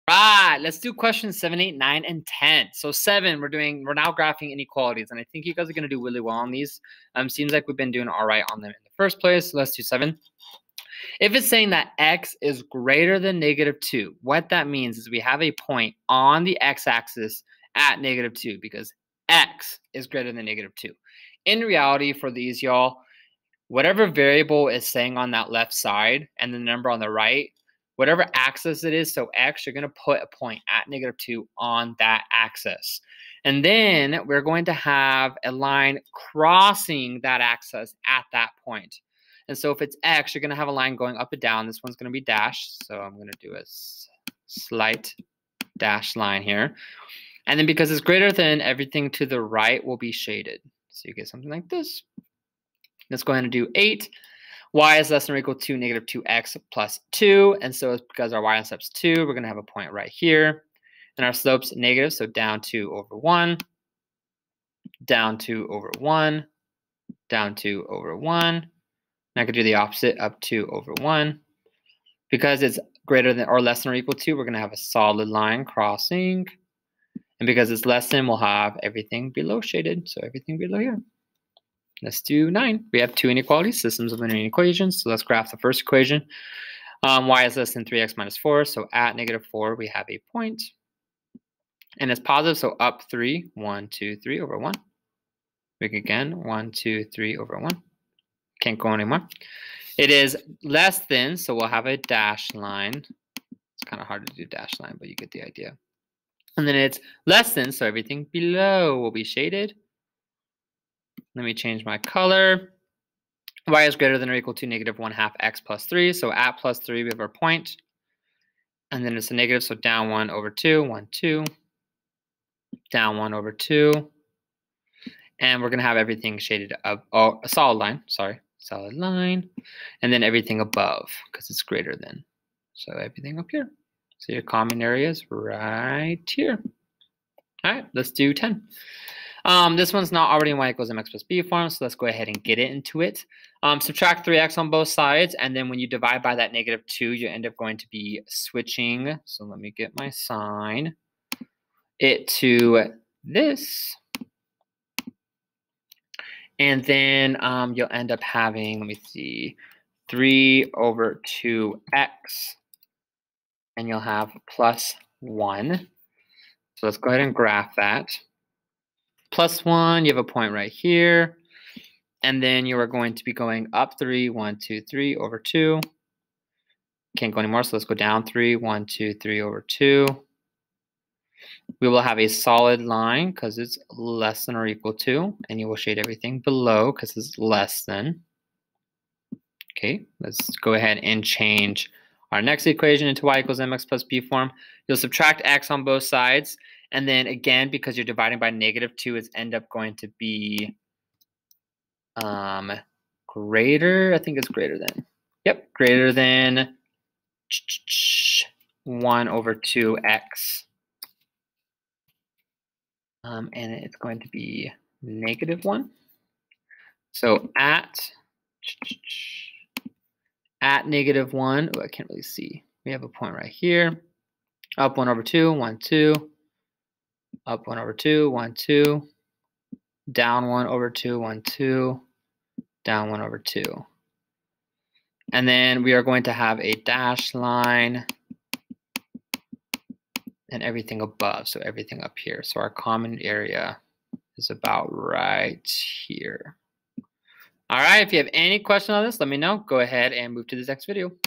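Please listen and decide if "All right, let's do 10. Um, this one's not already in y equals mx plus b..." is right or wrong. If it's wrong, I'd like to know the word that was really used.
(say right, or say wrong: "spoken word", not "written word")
right.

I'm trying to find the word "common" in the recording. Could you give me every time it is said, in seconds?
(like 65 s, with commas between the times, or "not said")
134 s, 242 s.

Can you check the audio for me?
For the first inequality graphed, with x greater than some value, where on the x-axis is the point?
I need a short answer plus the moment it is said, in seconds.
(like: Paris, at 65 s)
-2, at 30 s.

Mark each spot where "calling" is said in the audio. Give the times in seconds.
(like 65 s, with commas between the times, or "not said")
not said.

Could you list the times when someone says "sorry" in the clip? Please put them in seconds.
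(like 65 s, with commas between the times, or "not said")
128 s.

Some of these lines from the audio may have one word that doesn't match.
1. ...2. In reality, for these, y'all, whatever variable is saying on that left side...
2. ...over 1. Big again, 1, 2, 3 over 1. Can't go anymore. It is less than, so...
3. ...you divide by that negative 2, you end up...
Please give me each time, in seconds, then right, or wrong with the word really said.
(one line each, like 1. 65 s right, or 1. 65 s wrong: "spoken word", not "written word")
1. 20 s right
2. 94 s right
3. 145 s right.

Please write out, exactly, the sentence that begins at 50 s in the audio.
So you get something like this.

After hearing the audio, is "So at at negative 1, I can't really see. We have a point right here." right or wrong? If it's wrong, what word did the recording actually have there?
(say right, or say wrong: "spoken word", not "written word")
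right.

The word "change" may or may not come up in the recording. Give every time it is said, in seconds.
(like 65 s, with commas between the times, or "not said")
111 s, 191 s.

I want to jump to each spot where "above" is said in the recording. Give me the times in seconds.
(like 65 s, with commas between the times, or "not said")
130 s, 241 s.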